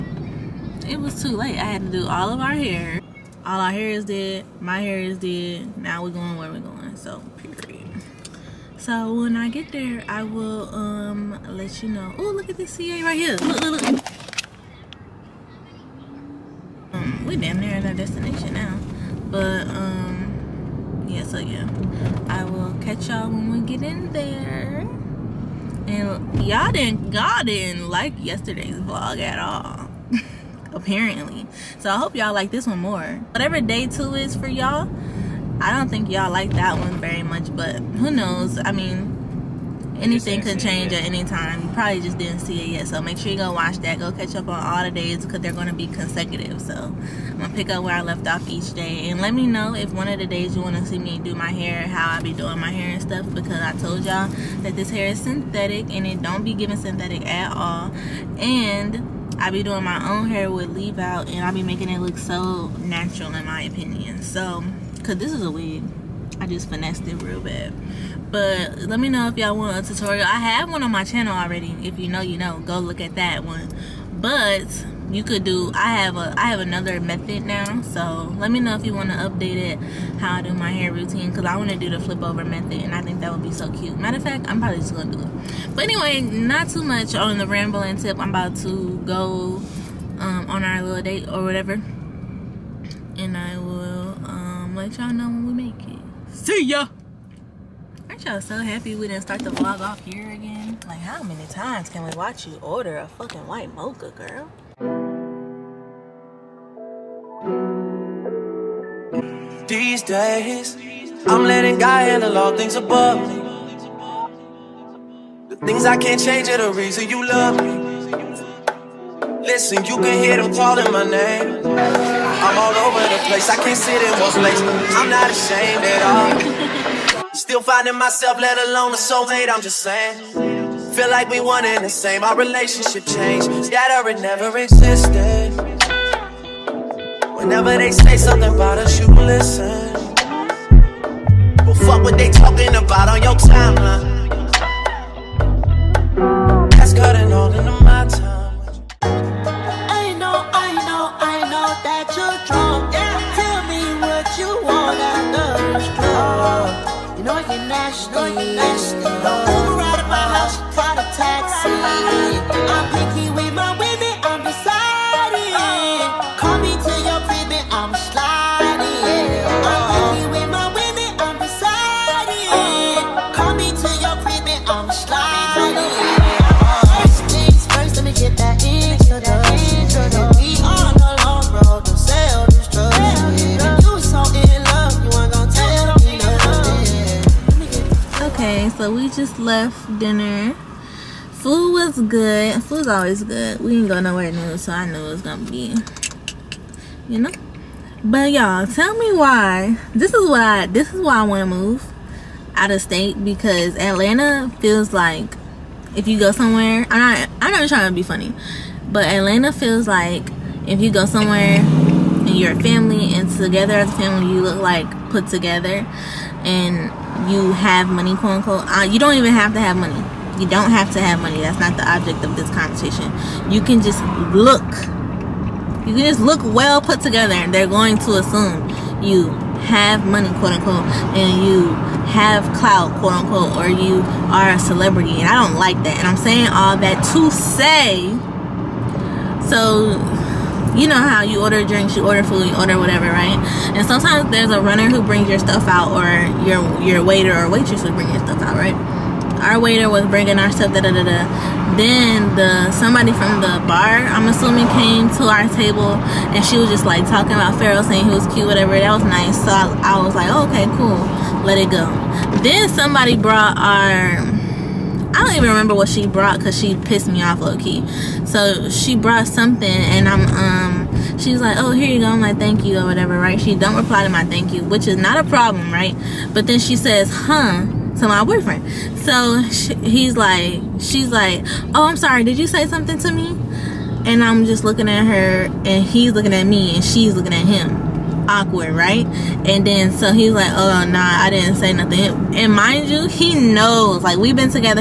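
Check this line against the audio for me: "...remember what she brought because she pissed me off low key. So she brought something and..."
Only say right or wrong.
right.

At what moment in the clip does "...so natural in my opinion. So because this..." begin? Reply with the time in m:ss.
1:02.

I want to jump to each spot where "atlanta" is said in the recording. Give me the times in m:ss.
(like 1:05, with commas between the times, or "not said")
3:23, 3:29.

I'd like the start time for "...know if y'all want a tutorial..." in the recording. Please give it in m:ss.
1:09.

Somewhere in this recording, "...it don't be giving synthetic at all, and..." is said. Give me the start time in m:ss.
0:56.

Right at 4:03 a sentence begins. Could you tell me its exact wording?
And sometimes there's a runner who brings your stuff out, or your your waiter or waitress would bring your stuff out, right?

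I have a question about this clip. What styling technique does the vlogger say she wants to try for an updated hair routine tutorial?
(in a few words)
flip over method.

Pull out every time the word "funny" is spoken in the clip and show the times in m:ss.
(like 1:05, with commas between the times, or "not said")
3:28.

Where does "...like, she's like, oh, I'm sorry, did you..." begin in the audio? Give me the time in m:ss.
4:40.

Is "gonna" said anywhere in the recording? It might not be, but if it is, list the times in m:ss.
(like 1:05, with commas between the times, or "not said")
0:47, 1:24, 3:15.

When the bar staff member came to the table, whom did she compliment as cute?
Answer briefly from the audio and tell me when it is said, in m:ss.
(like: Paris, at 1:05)
Pharaoh, at 4:17.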